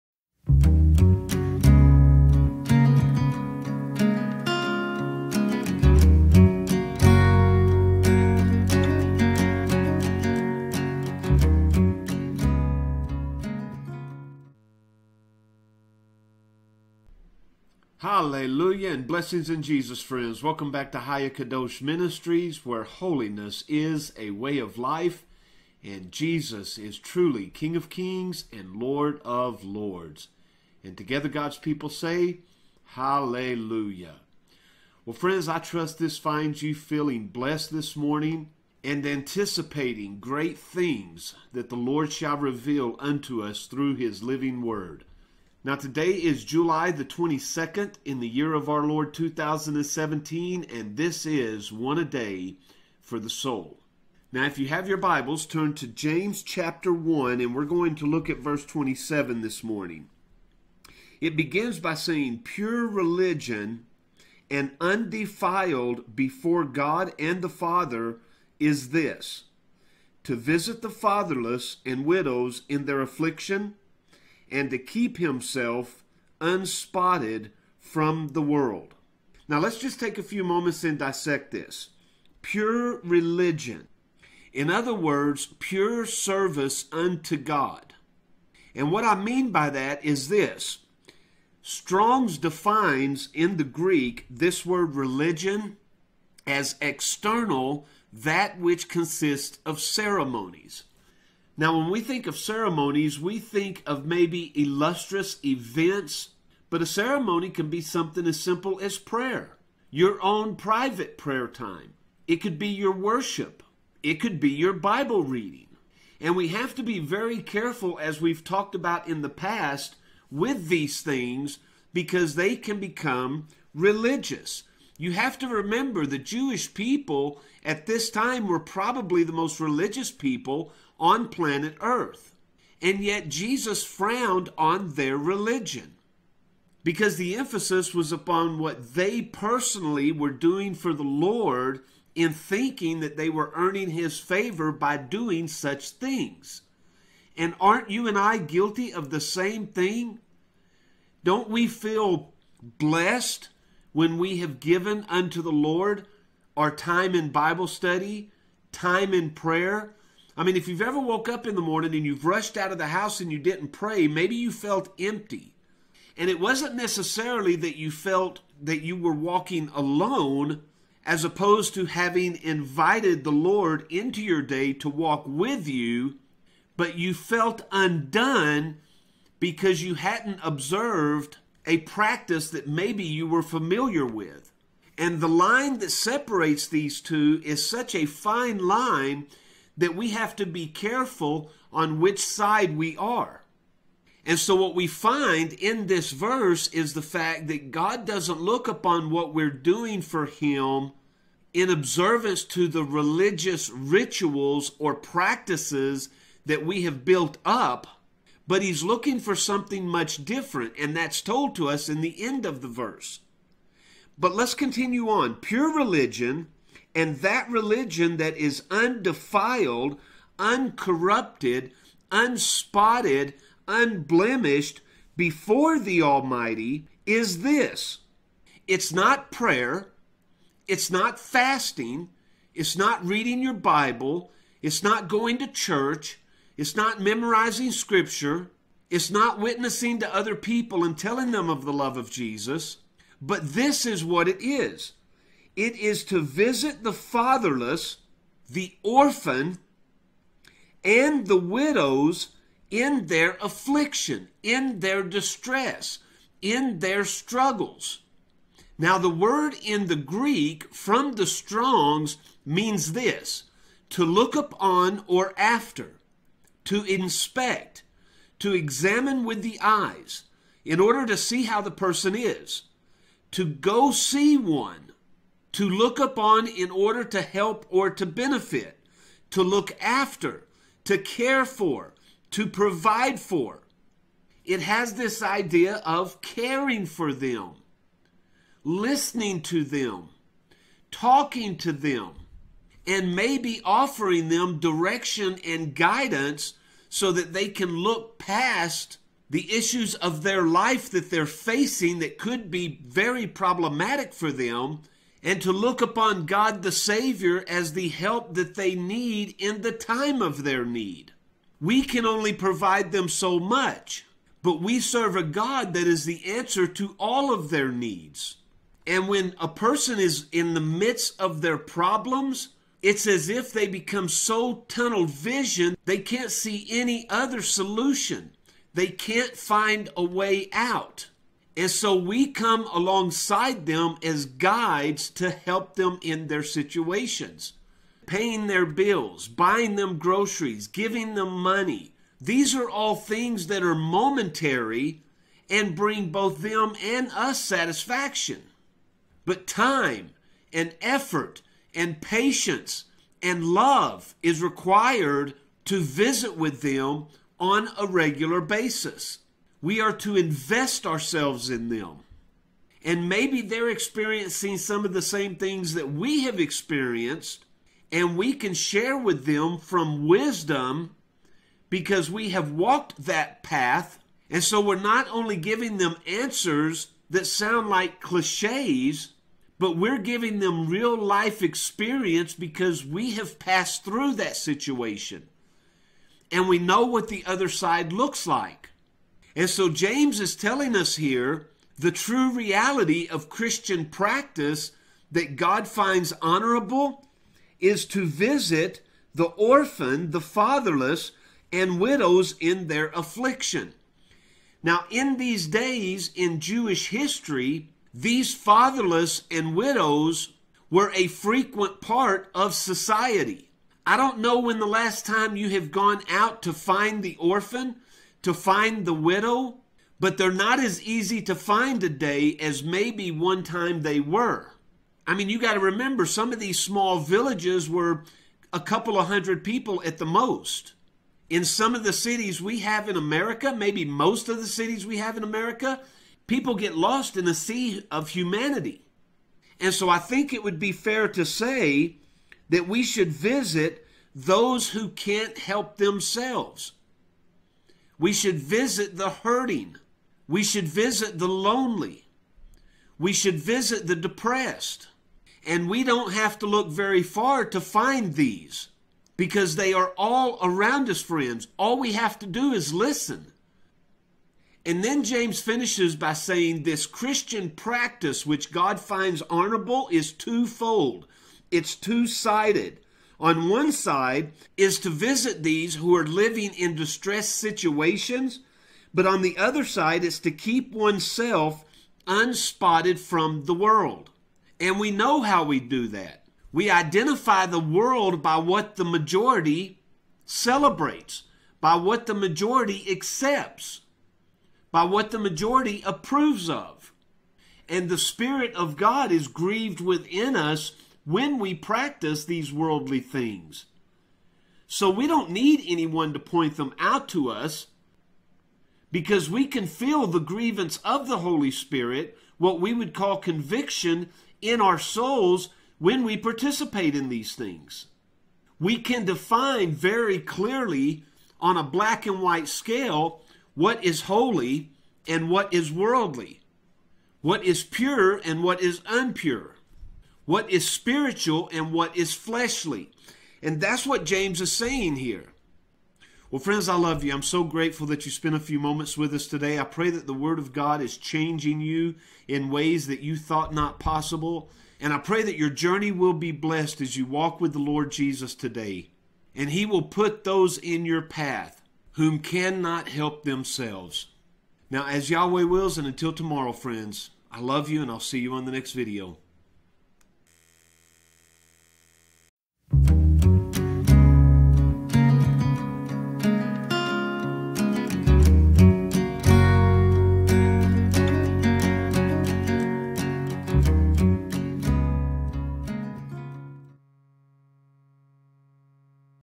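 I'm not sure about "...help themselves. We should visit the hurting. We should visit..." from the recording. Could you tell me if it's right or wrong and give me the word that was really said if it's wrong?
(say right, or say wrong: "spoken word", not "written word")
right.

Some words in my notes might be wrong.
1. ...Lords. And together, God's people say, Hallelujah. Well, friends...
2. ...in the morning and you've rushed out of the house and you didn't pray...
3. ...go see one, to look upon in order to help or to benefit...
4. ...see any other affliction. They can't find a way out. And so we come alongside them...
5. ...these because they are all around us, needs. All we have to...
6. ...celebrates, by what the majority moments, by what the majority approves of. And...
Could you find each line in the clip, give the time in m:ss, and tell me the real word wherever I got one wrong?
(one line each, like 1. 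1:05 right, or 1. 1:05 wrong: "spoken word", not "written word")
1. 0:29 right
2. 2:41 right
3. 4:33 right
4. 5:26 wrong: "solution", not "affliction"
5. 7:38 wrong: "friends", not "needs"
6. 8:10 wrong: "accepts", not "moments".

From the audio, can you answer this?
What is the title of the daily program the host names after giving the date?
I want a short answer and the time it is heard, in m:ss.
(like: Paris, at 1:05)
One a Day for the Soul, at 0:51.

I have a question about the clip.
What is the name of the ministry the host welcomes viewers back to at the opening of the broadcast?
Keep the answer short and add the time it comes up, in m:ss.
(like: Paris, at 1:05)
Higher Kadosh Ministries, at 0:20.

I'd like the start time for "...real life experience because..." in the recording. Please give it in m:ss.
6:20.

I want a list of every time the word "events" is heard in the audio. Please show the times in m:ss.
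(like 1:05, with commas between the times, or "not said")
1:45.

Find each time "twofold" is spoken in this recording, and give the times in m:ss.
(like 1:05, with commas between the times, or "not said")
7:50.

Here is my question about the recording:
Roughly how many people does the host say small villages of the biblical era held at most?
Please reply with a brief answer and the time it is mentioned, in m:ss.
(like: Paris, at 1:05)
a couple of hundred, at 7:08.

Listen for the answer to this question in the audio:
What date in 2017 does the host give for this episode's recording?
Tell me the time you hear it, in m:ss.
0:46.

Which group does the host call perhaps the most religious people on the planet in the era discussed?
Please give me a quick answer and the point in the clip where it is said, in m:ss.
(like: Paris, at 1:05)
the Jewish people, at 2:06.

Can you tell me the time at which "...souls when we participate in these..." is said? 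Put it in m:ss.
8:34.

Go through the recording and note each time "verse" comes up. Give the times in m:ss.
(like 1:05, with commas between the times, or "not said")
0:58, 3:16, 3:32.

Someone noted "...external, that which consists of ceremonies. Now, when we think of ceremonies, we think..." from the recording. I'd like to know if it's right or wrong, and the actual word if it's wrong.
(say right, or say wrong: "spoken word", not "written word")
right.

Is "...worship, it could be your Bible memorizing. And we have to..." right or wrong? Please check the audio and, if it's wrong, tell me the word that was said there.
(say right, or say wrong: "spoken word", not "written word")
wrong: "reading", not "memorizing".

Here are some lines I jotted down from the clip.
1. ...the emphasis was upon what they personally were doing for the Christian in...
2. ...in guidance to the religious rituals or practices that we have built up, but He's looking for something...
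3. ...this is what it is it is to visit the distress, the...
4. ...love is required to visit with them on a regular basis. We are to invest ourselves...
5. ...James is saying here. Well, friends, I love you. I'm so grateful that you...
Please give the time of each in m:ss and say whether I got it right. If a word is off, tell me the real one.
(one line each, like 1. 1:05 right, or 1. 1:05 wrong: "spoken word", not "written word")
1. 2:17 wrong: "Lord", not "Christian"
2. 3:21 wrong: "observance", not "guidance"
3. 4:03 wrong: "fatherless", not "distress"
4. 5:53 right
5. 8:54 right.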